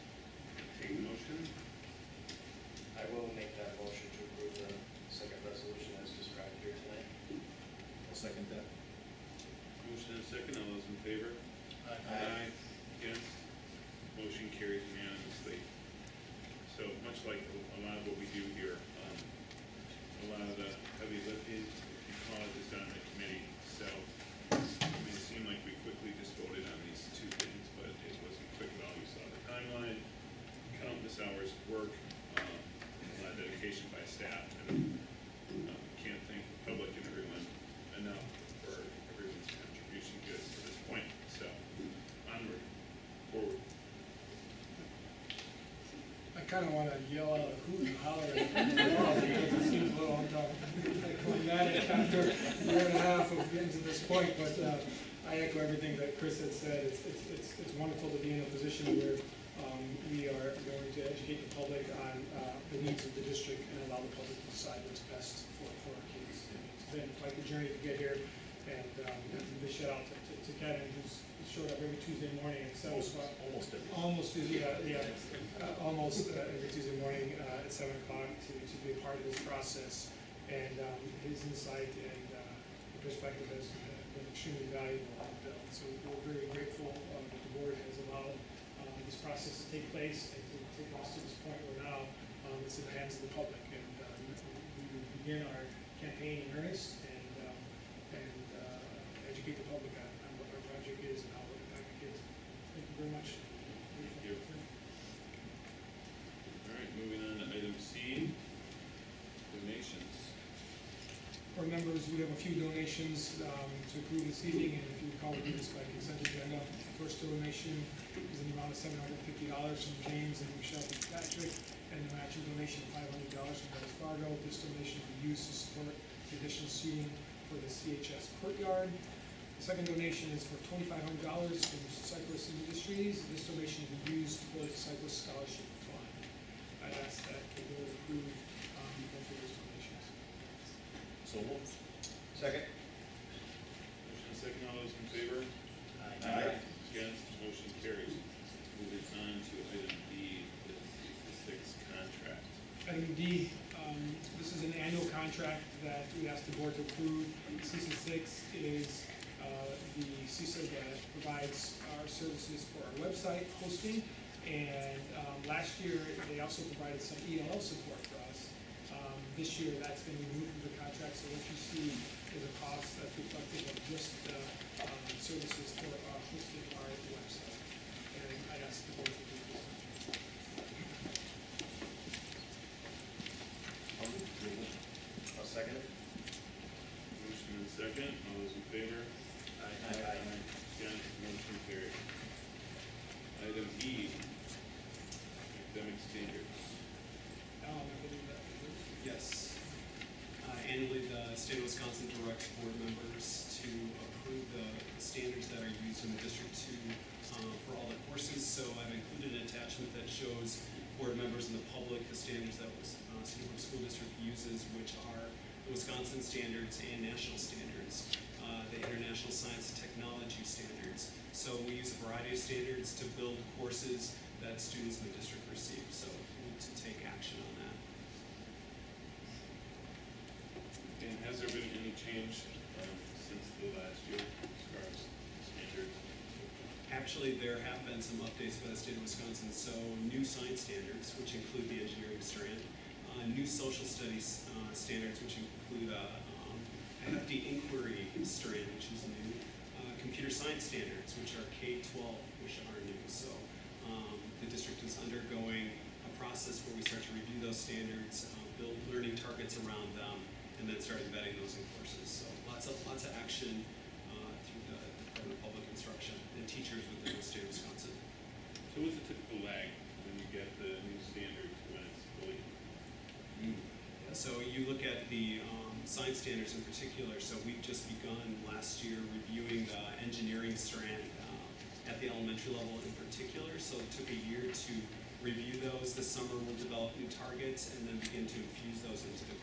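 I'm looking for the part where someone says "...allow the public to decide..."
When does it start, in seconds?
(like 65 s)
63 s.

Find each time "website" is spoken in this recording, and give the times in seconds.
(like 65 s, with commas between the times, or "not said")
163 s, 177 s.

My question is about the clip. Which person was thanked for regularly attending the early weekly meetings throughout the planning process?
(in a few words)
Kevin.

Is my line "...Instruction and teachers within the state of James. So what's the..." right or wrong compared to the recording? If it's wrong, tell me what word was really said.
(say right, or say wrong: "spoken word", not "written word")
wrong: "Wisconsin", not "James".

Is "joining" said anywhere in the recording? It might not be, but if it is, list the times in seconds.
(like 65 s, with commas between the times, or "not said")
not said.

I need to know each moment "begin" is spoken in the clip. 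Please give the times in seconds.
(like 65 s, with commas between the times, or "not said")
95 s, 287 s.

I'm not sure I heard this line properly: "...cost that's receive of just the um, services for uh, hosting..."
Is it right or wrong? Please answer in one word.
wrong.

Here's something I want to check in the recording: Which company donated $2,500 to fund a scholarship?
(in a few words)
Cyclist Industries.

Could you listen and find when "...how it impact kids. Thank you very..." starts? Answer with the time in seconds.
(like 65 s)
101 s.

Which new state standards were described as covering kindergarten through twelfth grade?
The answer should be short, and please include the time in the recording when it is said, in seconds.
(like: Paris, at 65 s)
computer science, at 250 s.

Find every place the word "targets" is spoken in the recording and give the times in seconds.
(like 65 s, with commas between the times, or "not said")
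259 s, 287 s.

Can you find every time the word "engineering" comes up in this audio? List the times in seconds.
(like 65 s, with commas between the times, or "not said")
241 s, 280 s.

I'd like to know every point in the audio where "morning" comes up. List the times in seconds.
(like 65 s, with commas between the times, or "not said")
72 s, 77 s.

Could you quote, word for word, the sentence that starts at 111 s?
For members, we have a few donations um, to approve this evening, and if you recall, we did this by consent agenda.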